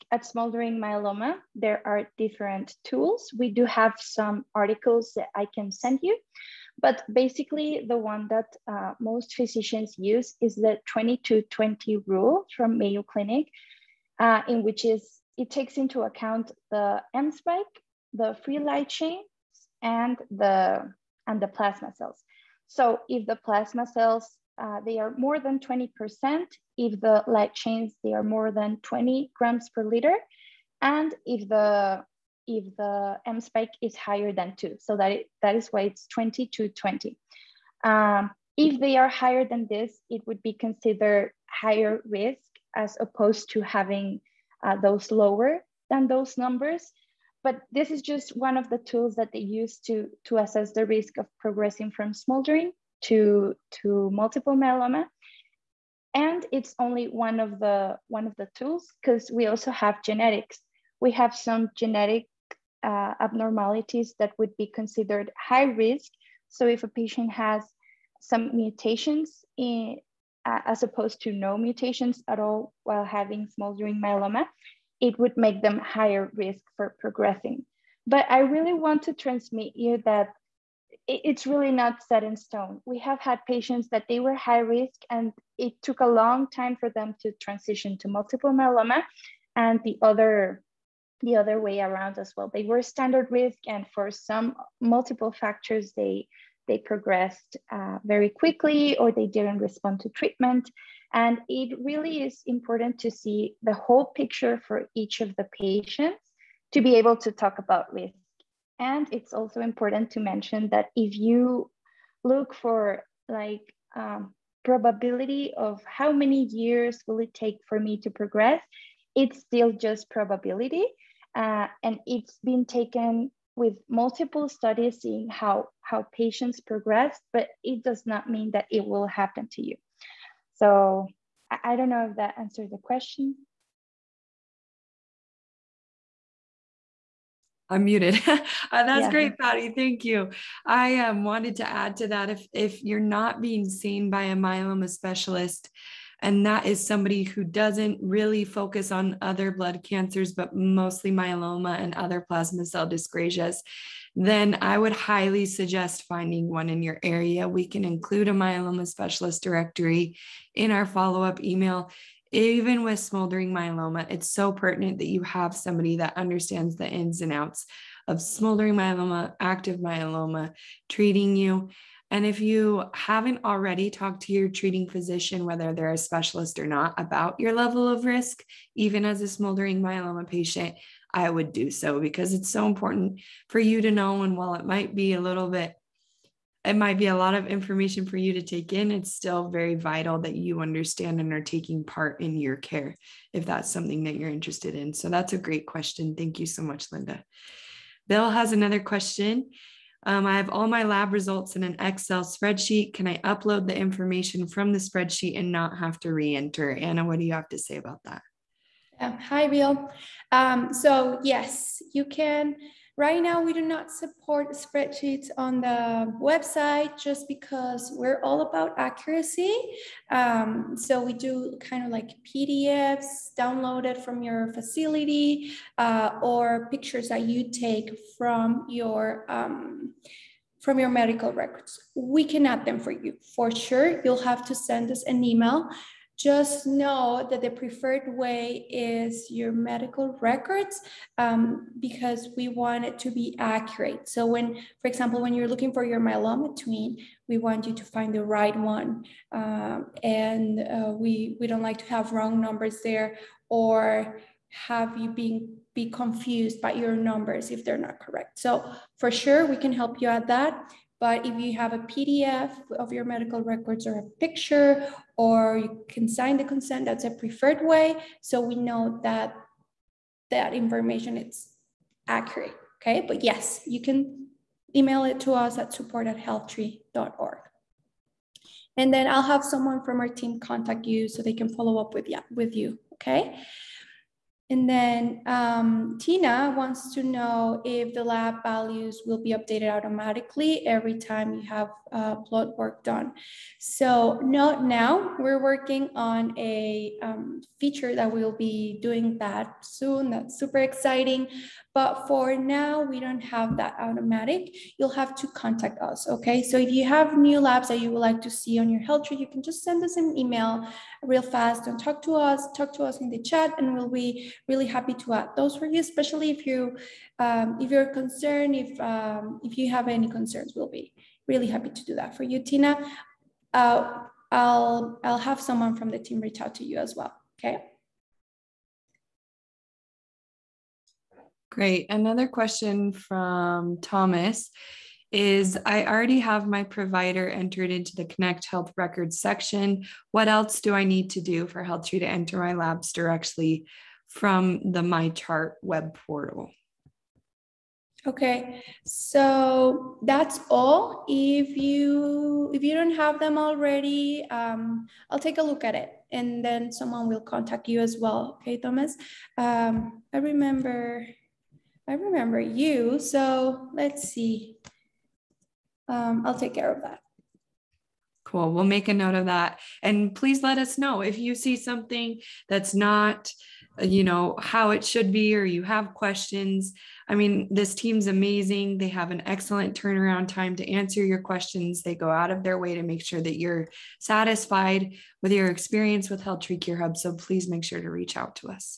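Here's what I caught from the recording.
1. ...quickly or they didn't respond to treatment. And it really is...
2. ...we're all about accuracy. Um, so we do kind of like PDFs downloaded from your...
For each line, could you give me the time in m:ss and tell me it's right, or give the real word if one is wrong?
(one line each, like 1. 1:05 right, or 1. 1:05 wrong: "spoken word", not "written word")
1. 1:38 right
2. 3:37 right.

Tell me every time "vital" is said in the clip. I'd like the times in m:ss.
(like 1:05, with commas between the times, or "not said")
3:09.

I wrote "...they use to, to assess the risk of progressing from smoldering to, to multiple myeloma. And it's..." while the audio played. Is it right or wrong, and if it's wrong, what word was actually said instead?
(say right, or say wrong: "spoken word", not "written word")
right.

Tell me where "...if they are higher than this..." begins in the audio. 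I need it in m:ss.
0:38.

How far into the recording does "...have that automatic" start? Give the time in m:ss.
5:03.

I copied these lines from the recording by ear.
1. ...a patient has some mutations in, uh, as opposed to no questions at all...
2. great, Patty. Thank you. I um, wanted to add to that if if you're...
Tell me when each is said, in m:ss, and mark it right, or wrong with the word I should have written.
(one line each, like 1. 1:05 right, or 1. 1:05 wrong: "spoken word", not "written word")
1. 1:06 wrong: "mutations", not "questions"
2. 2:19 right.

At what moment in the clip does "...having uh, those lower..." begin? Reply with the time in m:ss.
0:43.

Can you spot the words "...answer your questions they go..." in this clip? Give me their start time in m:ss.
6:20.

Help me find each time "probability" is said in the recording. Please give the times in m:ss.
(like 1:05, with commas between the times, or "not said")
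1:54, 2:00.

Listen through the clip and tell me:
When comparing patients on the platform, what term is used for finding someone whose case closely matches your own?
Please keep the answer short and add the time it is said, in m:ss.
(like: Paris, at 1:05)
myeloma twin, at 4:05.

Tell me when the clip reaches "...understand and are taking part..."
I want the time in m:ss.
3:10.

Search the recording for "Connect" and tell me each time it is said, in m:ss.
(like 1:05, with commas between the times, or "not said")
5:38.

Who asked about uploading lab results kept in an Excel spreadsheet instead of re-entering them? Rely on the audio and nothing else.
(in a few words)
Bill.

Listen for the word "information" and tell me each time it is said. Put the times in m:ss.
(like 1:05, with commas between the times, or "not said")
3:07, 3:23, 4:30.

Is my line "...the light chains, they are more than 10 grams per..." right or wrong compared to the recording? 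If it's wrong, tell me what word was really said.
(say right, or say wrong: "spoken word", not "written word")
wrong: "20", not "10".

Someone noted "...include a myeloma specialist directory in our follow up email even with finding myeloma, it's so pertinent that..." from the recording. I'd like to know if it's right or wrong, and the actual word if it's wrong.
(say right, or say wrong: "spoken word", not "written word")
wrong: "smoldering", not "finding".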